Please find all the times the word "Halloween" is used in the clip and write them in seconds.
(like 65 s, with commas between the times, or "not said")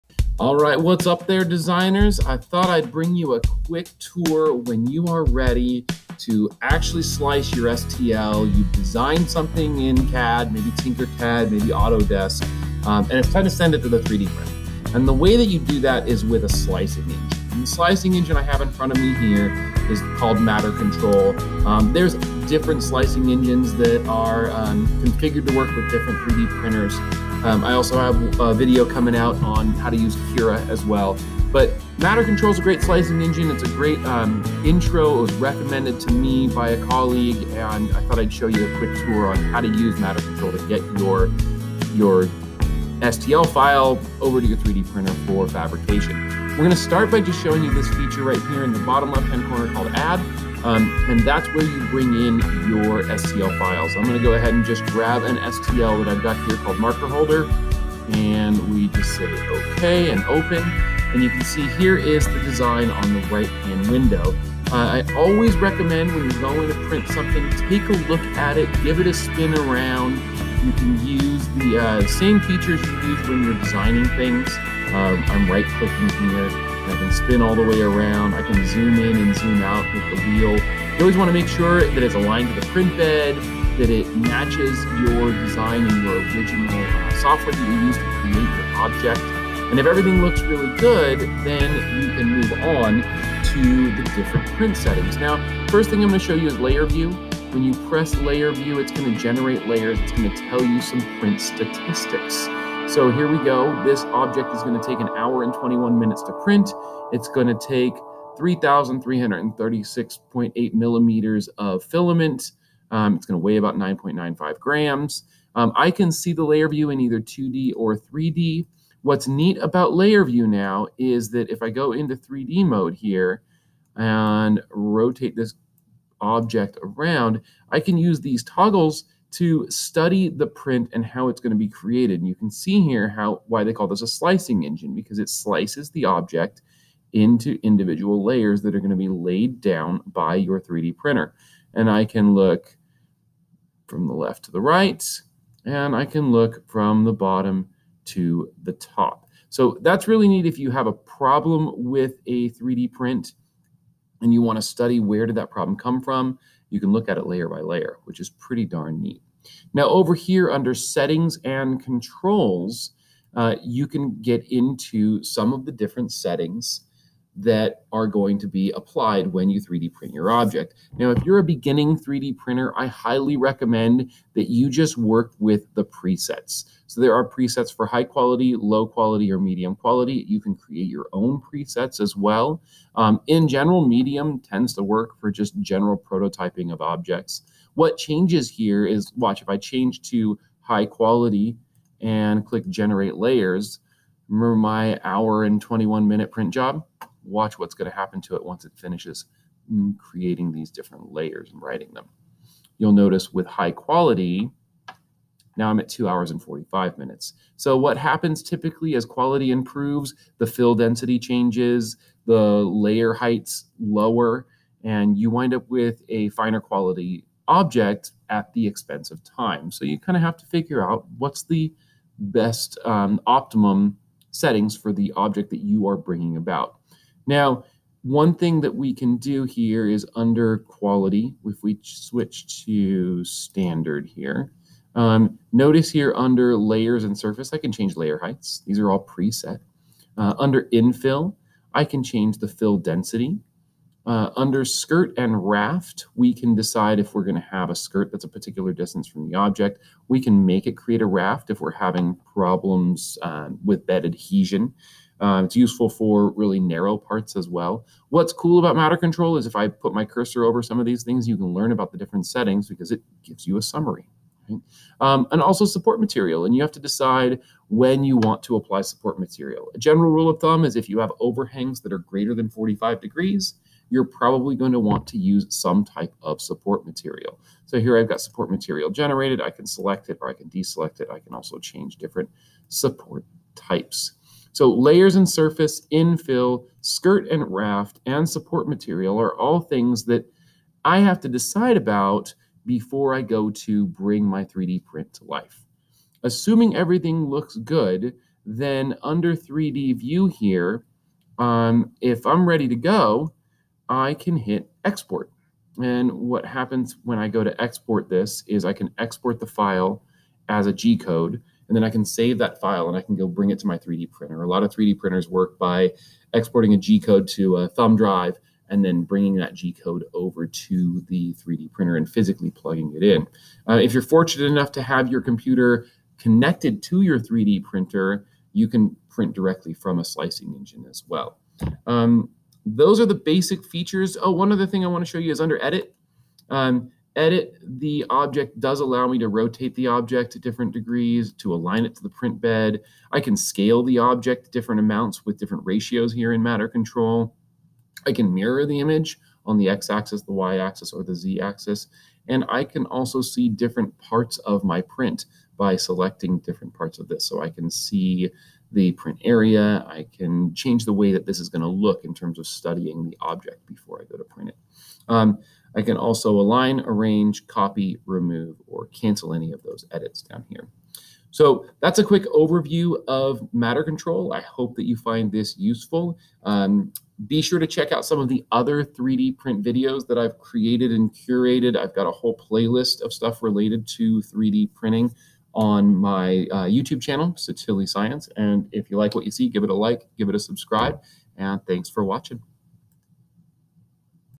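not said.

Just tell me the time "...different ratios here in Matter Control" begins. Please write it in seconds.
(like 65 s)
345 s.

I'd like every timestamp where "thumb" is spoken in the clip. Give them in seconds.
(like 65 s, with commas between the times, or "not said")
270 s, 317 s.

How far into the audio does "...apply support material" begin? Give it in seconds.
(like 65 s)
268 s.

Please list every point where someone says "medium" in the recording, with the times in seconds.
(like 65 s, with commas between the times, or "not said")
179 s, 183 s.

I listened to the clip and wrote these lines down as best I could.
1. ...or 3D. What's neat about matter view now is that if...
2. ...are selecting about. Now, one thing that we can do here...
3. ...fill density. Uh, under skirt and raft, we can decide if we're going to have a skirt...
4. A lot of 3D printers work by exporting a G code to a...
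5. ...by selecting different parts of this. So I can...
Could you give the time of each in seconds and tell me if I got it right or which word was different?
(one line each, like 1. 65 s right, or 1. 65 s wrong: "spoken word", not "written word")
1. 117 s wrong: "layer", not "matter"
2. 225 s wrong: "bringing", not "selecting"
3. 242 s right
4. 314 s right
5. 355 s right.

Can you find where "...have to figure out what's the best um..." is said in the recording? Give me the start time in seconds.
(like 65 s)
220 s.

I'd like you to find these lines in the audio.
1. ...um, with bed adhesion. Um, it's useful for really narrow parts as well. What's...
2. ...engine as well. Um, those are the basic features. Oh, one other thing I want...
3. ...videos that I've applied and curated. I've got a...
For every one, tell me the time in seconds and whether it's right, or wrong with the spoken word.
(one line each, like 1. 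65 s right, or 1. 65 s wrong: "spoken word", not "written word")
1. 253 s right
2. 330 s right
3. 379 s wrong: "created", not "applied".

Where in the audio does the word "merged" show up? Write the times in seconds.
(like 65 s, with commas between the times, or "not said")
not said.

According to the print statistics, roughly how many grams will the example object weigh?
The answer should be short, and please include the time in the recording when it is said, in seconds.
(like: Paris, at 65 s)
9.95 grams, at 113 s.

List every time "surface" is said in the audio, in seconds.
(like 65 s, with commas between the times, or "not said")
237 s, 285 s.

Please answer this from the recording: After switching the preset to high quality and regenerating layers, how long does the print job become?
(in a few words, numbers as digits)
2 hours 45 minutes.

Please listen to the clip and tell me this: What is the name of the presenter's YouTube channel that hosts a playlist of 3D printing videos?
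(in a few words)
Sottile Science.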